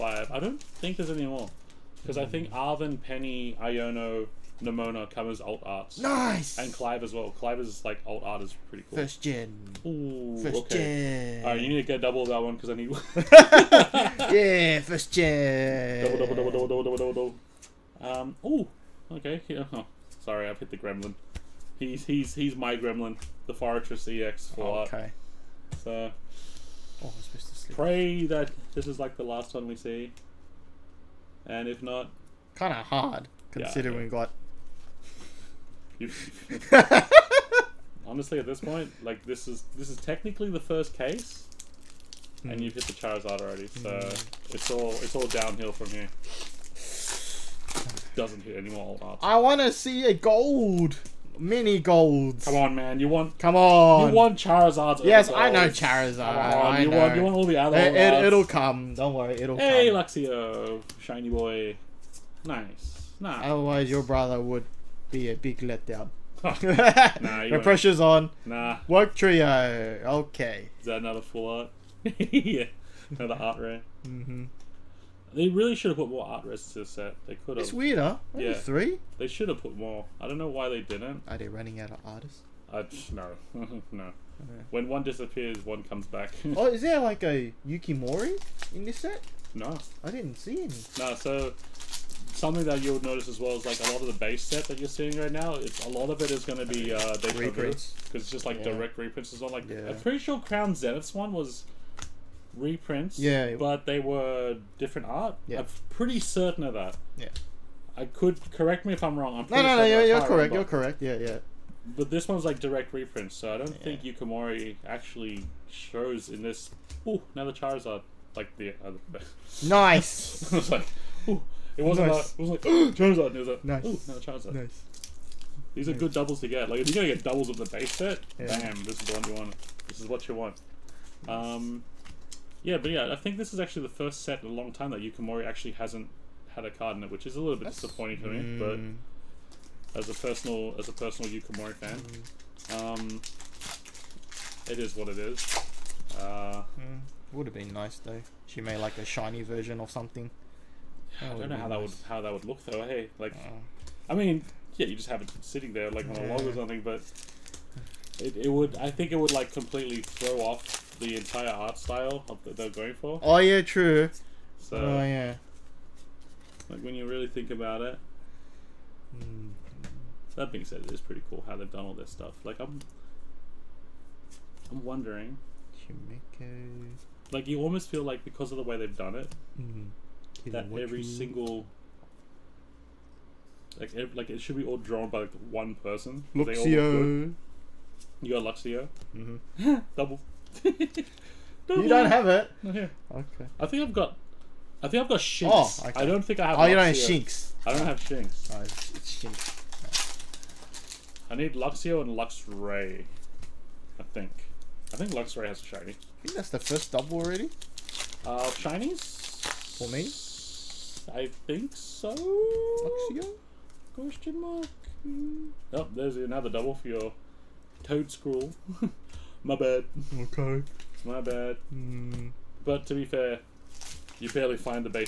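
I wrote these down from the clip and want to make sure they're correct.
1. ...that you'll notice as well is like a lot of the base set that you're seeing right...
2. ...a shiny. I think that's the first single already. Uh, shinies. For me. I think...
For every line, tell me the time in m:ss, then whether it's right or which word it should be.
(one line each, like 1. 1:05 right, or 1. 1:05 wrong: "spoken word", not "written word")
1. 1:32 right
2. 3:25 wrong: "double", not "single".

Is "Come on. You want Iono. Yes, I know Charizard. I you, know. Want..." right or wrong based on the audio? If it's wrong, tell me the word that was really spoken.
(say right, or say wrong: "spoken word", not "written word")
wrong: "Charizards", not "Iono".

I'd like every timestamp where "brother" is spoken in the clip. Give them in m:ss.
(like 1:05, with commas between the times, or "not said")
1:04.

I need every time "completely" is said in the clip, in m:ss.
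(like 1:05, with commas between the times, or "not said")
2:39.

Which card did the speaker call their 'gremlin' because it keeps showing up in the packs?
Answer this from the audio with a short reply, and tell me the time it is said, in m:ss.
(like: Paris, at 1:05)
Forretress EX, at 0:23.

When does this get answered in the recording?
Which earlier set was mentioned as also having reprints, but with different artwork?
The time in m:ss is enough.
1:40.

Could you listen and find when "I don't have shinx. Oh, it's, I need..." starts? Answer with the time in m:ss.
3:17.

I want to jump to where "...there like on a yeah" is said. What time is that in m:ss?
2:35.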